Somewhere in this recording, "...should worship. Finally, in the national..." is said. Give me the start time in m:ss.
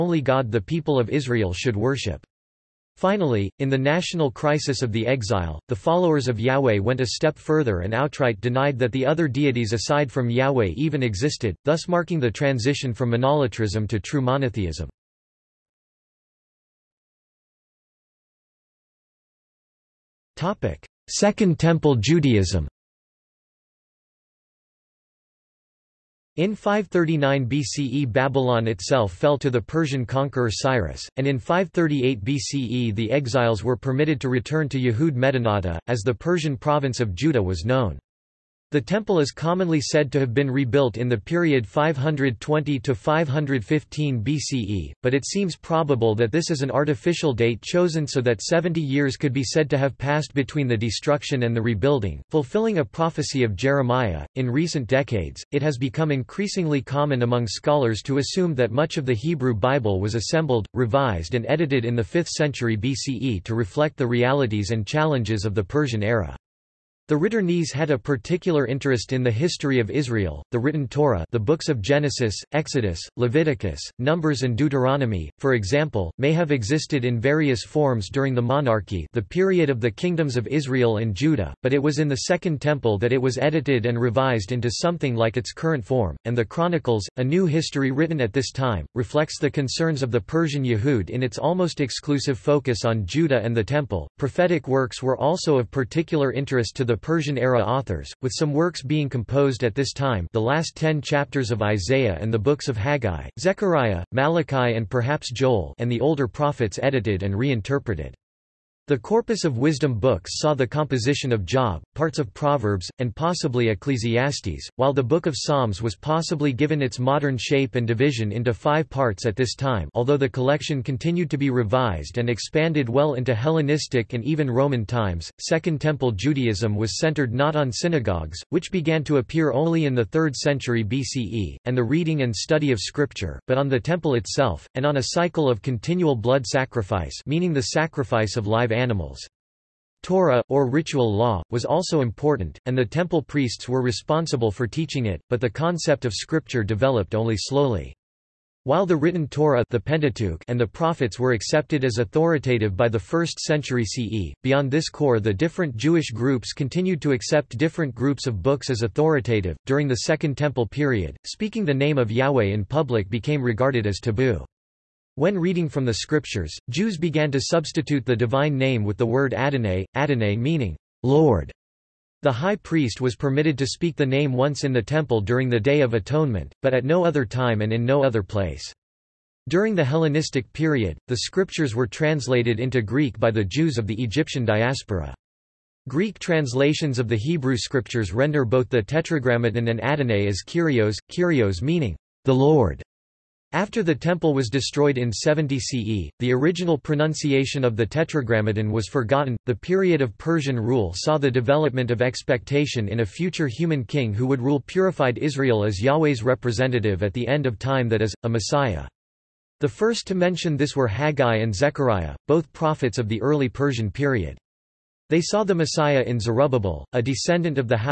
0:01.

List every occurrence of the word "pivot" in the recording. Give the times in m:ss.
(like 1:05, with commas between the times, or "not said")
not said.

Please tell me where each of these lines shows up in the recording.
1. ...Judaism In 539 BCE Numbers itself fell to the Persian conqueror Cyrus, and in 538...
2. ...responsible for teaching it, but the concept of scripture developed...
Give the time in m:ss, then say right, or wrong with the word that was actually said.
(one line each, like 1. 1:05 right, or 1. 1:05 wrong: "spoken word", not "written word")
1. 0:21 wrong: "Babylon", not "Numbers"
2. 2:23 right.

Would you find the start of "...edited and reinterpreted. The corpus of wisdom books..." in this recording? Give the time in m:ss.
1:46.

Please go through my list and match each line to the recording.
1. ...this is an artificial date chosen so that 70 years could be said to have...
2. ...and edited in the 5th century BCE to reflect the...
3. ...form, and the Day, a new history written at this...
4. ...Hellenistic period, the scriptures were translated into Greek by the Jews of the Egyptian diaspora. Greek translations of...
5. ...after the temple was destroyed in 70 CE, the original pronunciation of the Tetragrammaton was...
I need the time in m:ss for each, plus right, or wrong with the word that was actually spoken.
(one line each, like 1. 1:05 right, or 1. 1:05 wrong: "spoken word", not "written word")
1. 0:46 right
2. 1:01 right
3. 1:25 wrong: "Chronicles", not "Day"
4. 2:59 right
5. 3:13 right.